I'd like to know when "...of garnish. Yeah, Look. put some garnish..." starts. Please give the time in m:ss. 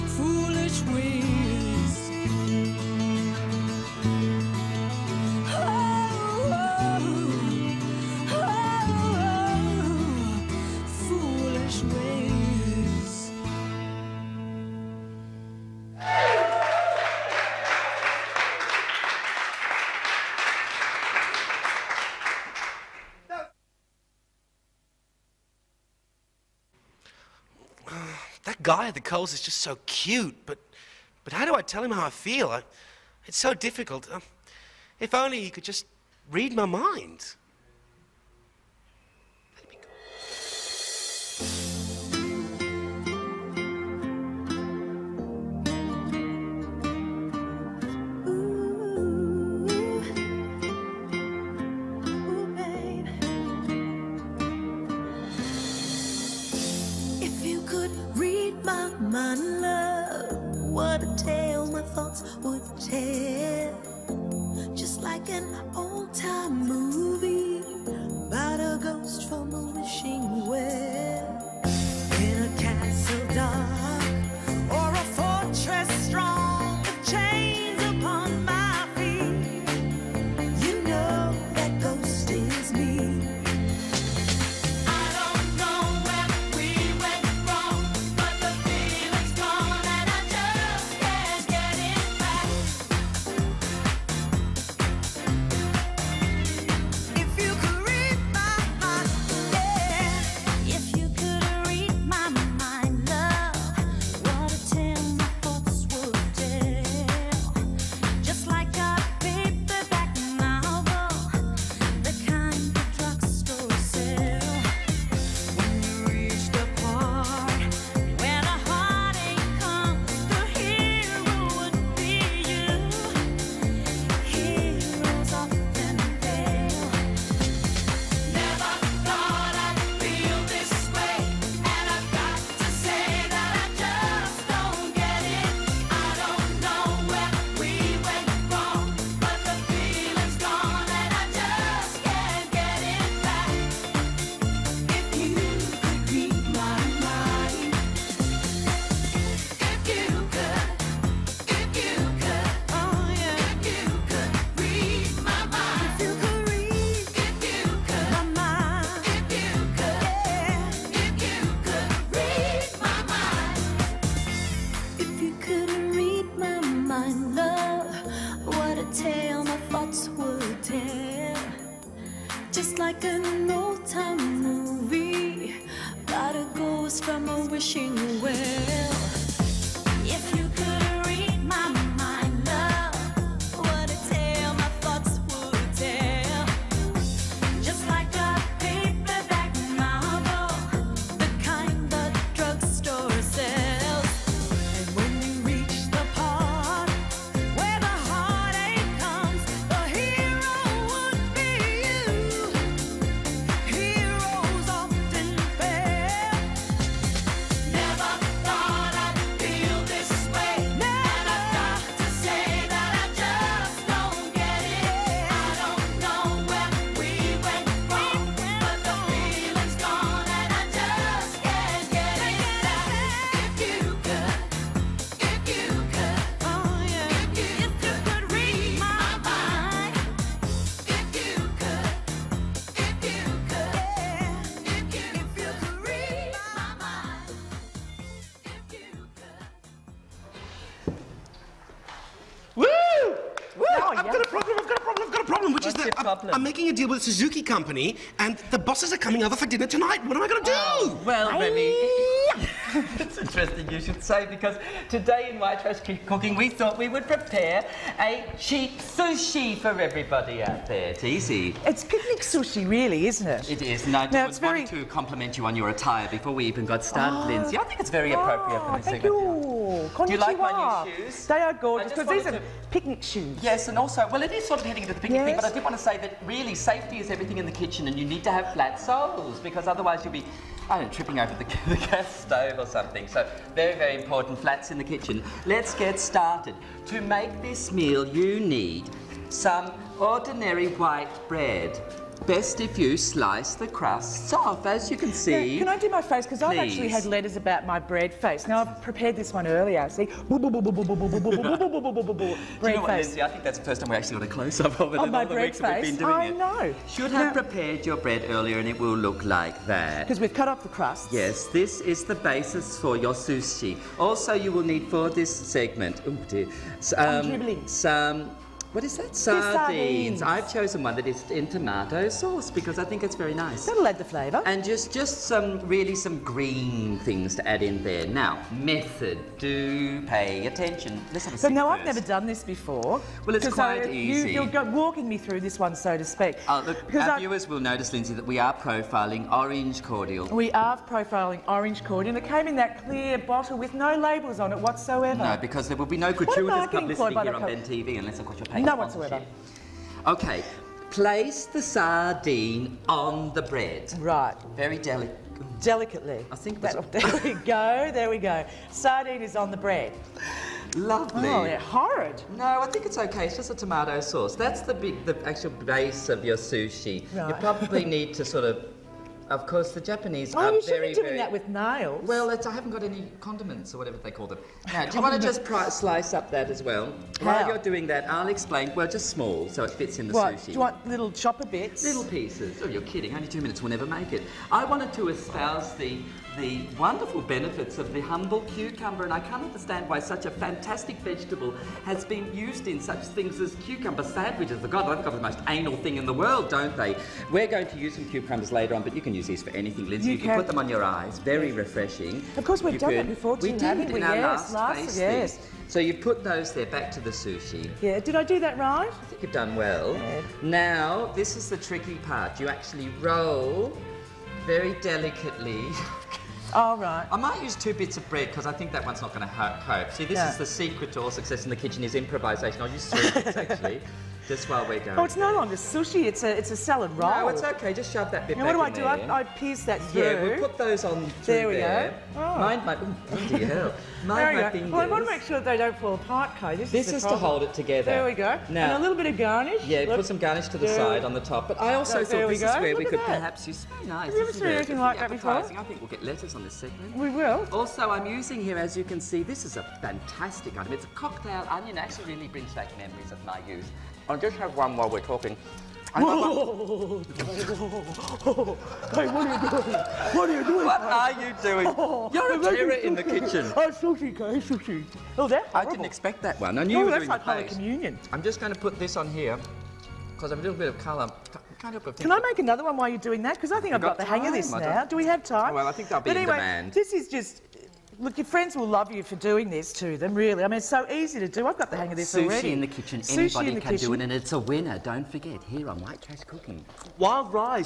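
7:19.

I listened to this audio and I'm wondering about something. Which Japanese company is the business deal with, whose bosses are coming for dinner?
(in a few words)
Suzuki.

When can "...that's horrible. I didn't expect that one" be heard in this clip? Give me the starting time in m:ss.
7:45.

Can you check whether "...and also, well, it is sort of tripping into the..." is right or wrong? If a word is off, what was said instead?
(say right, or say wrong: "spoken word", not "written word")
wrong: "heading", not "tripping".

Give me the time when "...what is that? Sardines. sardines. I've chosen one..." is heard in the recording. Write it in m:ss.
5:18.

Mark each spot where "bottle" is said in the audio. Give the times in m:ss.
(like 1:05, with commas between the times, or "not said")
5:43.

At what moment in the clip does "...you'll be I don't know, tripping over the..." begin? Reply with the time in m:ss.
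4:40.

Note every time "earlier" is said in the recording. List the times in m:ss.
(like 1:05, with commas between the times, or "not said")
4:59, 5:08.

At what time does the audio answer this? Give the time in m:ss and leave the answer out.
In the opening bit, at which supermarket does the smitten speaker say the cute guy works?
0:28.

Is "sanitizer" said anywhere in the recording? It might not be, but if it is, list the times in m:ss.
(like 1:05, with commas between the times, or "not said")
not said.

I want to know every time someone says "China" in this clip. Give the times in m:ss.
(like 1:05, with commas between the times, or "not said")
not said.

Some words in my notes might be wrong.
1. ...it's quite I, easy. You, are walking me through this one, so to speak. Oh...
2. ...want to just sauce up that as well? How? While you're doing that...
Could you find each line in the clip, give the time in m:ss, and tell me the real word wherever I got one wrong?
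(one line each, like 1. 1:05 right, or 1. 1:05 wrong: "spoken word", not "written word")
1. 5:33 right
2. 6:15 wrong: "slice", not "sauce".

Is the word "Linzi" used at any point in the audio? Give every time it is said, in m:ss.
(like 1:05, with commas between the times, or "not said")
4:27, 5:37, 6:39.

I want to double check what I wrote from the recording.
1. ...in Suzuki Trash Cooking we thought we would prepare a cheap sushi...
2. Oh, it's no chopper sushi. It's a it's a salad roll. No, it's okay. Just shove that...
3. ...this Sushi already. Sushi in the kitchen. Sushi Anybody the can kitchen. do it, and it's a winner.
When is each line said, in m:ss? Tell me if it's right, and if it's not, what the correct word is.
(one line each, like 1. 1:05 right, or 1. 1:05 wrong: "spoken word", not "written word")
1. 4:15 wrong: "White", not "Suzuki"
2. 7:04 wrong: "longer", not "chopper"
3. 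8:01 right.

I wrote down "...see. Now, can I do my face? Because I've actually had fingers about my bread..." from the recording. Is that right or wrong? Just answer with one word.
wrong.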